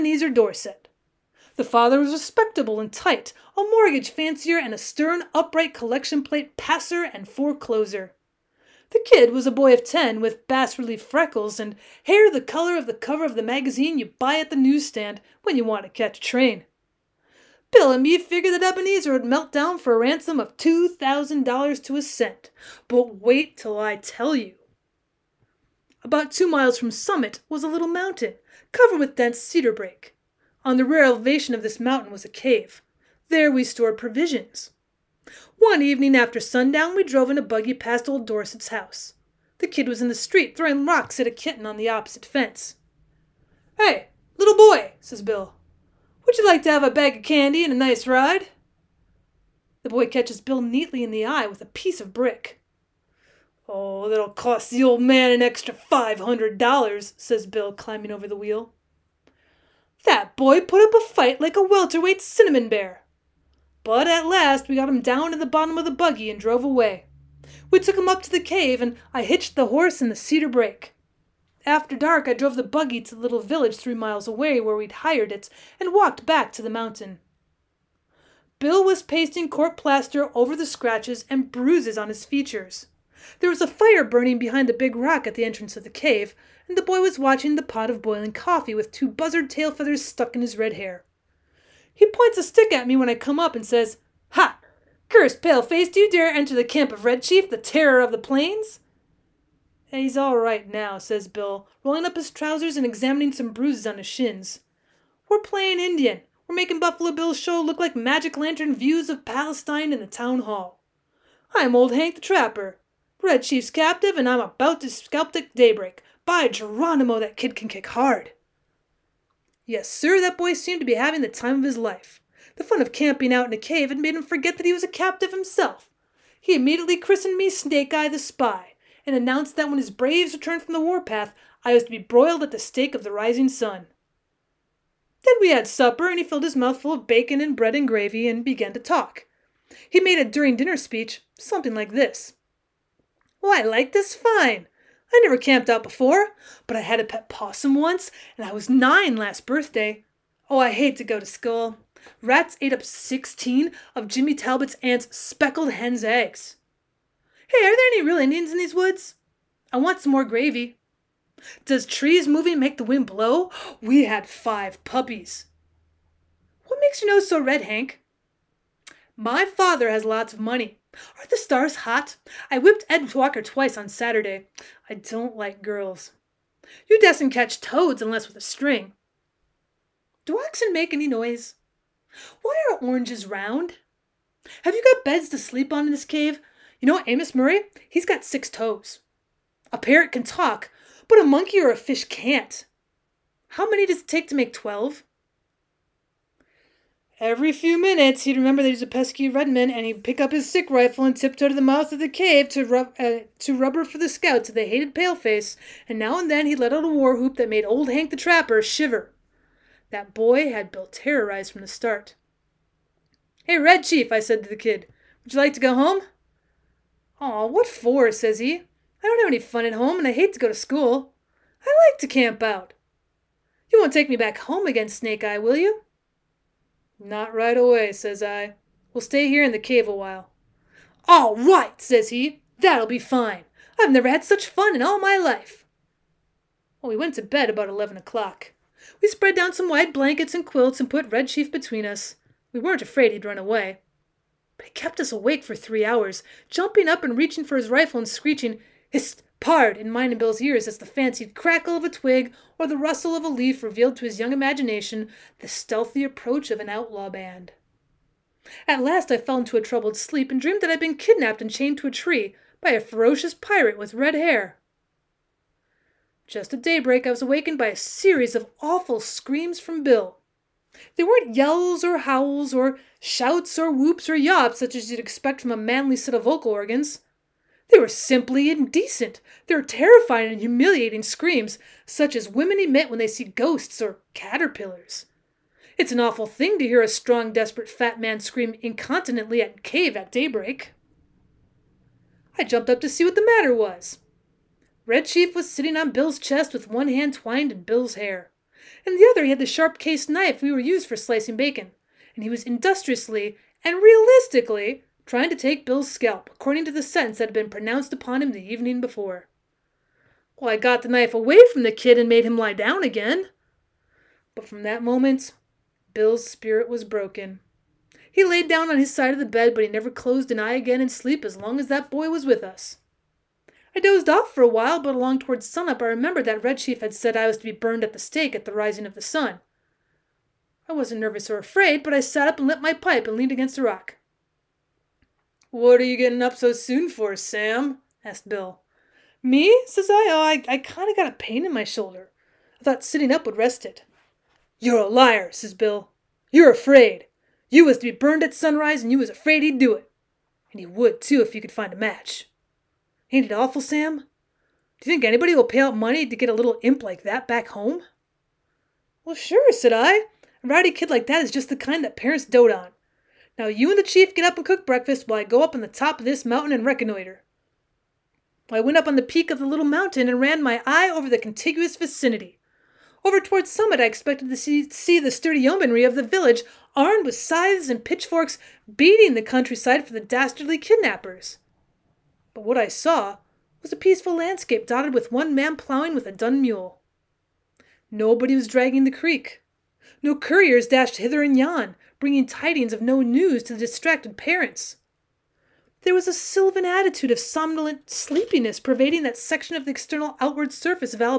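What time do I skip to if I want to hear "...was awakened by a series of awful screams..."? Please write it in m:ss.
4:27.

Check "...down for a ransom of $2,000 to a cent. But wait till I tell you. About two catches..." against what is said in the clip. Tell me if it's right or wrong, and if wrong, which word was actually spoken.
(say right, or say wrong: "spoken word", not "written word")
wrong: "miles", not "catches".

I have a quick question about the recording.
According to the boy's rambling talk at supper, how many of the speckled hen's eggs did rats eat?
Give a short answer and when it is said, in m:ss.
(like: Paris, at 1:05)
16, at 2:32.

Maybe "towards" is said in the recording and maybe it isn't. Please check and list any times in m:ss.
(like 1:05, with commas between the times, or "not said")
5:25, 6:13.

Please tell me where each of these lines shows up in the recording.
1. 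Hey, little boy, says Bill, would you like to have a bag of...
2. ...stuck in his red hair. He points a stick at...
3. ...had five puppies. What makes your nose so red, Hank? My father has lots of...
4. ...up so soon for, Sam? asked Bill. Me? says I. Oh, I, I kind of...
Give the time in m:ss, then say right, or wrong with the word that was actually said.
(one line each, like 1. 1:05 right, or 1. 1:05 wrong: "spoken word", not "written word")
1. 0:43 right
2. 1:30 right
3. 2:44 right
4. 5:36 right.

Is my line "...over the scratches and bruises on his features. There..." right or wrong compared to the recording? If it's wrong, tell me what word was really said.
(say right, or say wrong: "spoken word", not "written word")
right.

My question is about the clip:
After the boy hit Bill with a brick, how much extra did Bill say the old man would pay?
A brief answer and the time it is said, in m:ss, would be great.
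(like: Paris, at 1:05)
$500, at 0:55.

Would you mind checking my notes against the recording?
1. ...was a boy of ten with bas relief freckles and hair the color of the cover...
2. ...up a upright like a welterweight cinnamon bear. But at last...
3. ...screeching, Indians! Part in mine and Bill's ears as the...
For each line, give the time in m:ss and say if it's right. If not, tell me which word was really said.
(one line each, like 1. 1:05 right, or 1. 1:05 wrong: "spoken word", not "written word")
1. 0:09 right
2. 1:00 wrong: "fight", not "upright"
3. 4:08 wrong: "Hist", not "Indians".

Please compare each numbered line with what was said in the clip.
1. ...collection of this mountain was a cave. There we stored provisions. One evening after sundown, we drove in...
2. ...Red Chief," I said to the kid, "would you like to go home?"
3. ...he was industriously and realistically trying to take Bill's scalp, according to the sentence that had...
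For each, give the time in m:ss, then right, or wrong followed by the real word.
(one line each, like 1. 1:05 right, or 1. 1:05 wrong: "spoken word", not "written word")
1. 0:31 wrong: "elevation", not "collection"
2. 3:33 right
3. 5:02 right.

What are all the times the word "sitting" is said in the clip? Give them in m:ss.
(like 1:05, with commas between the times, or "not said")
4:55, 5:42.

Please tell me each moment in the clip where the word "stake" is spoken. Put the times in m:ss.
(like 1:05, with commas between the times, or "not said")
2:12, 5:27.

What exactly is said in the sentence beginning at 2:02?
The fun of camping out in a cave had made him forget that he was a captive himself.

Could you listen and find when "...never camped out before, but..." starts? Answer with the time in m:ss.
2:25.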